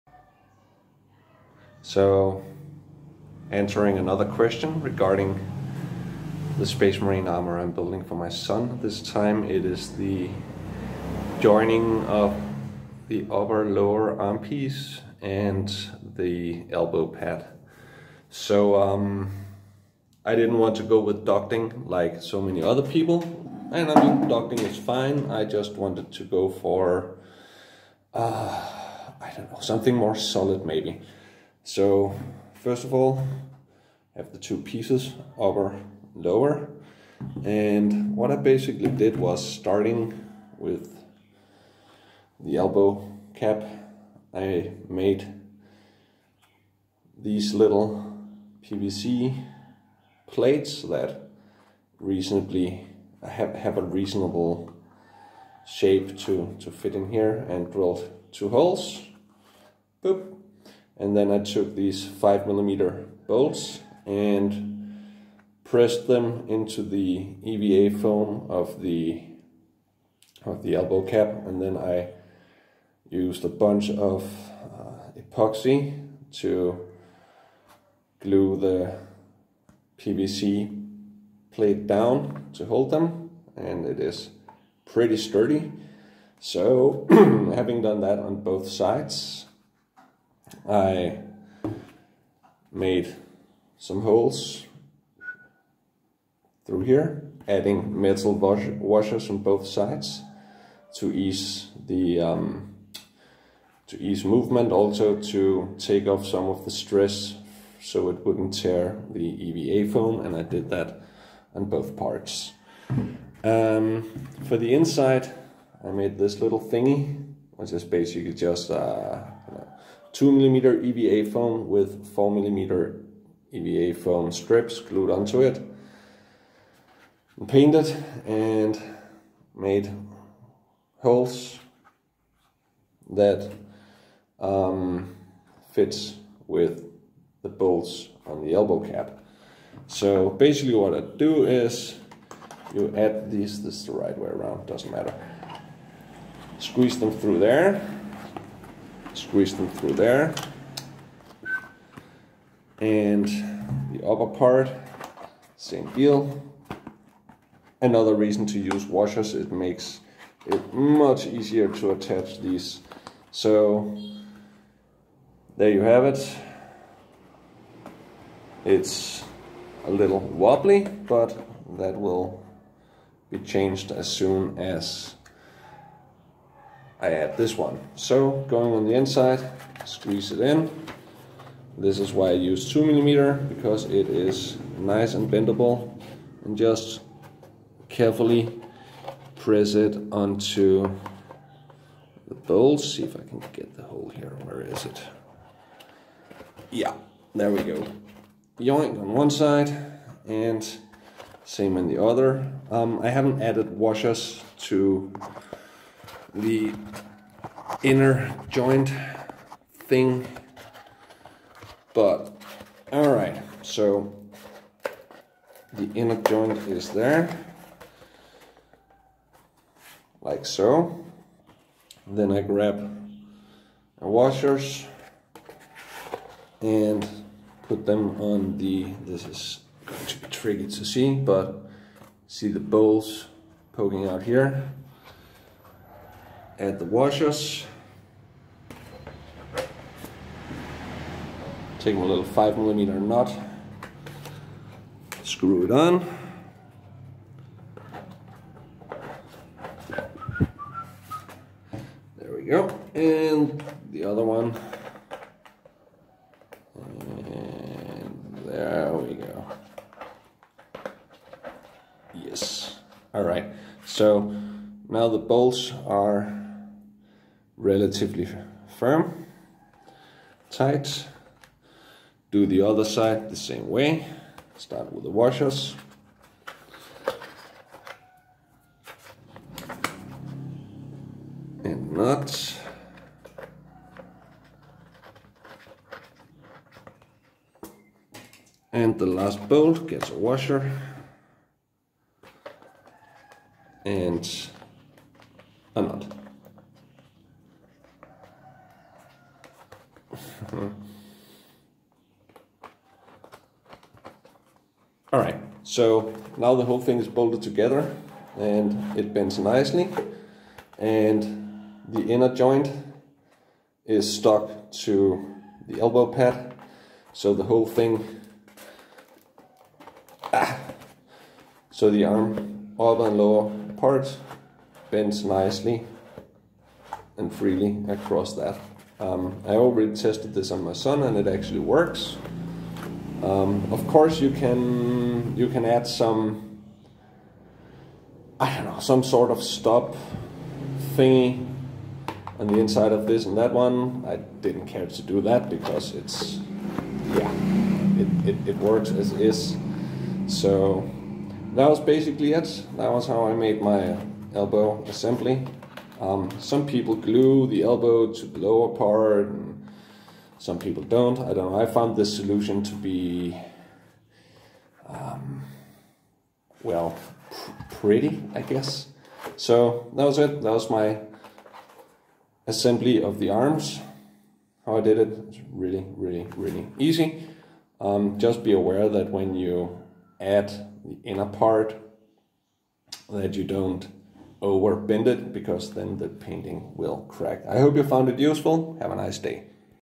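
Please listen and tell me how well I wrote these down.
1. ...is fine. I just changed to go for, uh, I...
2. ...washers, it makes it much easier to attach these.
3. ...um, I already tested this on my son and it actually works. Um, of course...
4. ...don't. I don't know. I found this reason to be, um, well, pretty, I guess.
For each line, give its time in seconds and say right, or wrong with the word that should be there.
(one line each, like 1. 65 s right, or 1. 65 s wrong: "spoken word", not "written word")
1. 24 s wrong: "wanted", not "changed"
2. 158 s right
3. 329 s right
4. 360 s wrong: "solution", not "reason".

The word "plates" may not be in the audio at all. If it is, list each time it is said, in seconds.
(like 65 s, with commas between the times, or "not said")
50 s, 81 s.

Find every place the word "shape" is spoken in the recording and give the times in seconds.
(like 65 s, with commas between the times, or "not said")
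55 s.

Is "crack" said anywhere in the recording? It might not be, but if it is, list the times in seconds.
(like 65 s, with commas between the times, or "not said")
387 s.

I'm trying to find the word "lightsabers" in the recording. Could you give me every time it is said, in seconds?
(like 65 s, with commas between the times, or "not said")
not said.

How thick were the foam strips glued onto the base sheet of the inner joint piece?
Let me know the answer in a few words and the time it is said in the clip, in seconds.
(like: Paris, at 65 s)
4 millimeter, at 122 s.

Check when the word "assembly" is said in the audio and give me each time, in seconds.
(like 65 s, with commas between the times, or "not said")
354 s, 372 s.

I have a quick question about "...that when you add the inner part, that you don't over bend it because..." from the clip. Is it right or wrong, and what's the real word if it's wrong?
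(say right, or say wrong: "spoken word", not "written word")
right.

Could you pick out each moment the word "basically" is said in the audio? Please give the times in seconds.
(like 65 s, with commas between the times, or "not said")
38 s, 117 s, 140 s, 351 s.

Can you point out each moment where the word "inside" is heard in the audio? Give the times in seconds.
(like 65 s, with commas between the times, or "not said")
114 s, 178 s, 342 s.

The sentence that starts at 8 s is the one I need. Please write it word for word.
This time it is the joining of the upper lower arm piece and the elbow pad.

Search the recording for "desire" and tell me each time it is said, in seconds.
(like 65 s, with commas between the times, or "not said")
not said.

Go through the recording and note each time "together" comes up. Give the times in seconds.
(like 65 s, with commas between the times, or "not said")
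307 s.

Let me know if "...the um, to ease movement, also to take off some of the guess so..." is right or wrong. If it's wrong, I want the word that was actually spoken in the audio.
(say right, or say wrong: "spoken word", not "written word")
wrong: "stress", not "guess".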